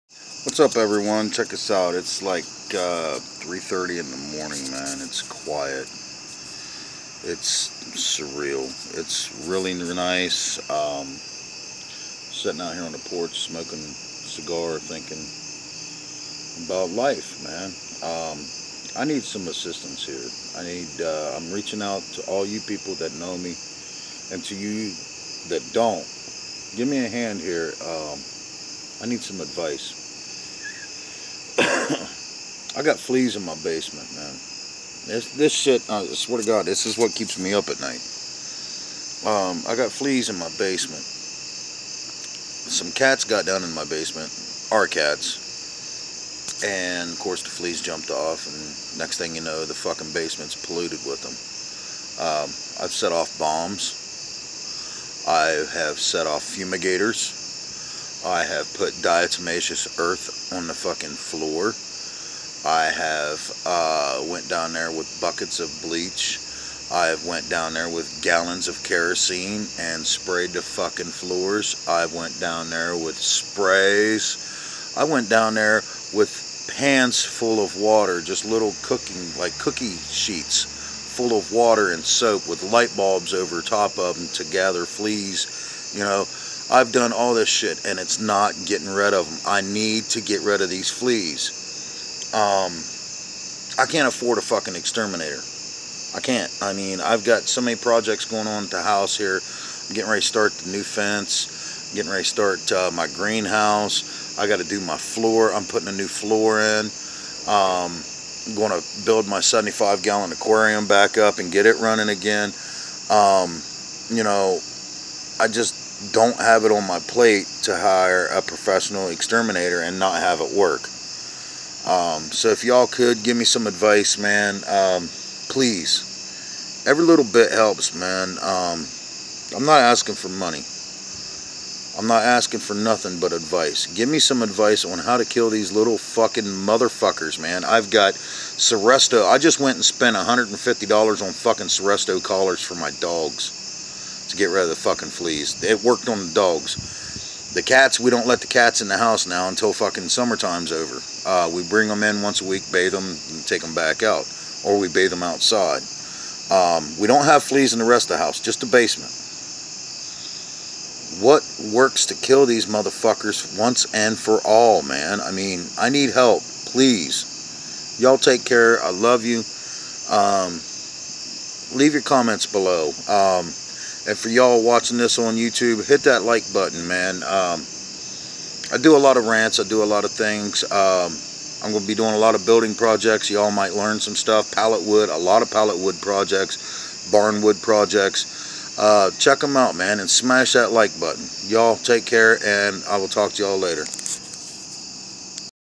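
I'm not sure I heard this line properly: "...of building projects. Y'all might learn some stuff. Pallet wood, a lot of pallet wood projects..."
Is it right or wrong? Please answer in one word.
right.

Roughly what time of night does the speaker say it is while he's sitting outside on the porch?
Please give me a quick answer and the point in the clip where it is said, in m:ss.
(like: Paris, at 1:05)
3:30 in the morning, at 0:03.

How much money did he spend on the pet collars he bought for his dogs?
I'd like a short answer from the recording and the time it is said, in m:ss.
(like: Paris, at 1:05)
$150, at 2:20.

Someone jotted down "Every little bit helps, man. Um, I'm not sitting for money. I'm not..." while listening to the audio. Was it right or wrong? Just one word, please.
wrong.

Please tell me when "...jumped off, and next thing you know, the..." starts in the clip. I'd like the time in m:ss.
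0:47.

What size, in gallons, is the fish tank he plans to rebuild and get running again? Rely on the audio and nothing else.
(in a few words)
75 gallon.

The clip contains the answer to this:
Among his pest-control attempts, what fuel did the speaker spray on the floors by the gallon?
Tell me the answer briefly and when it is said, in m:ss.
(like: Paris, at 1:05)
kerosene, at 1:08.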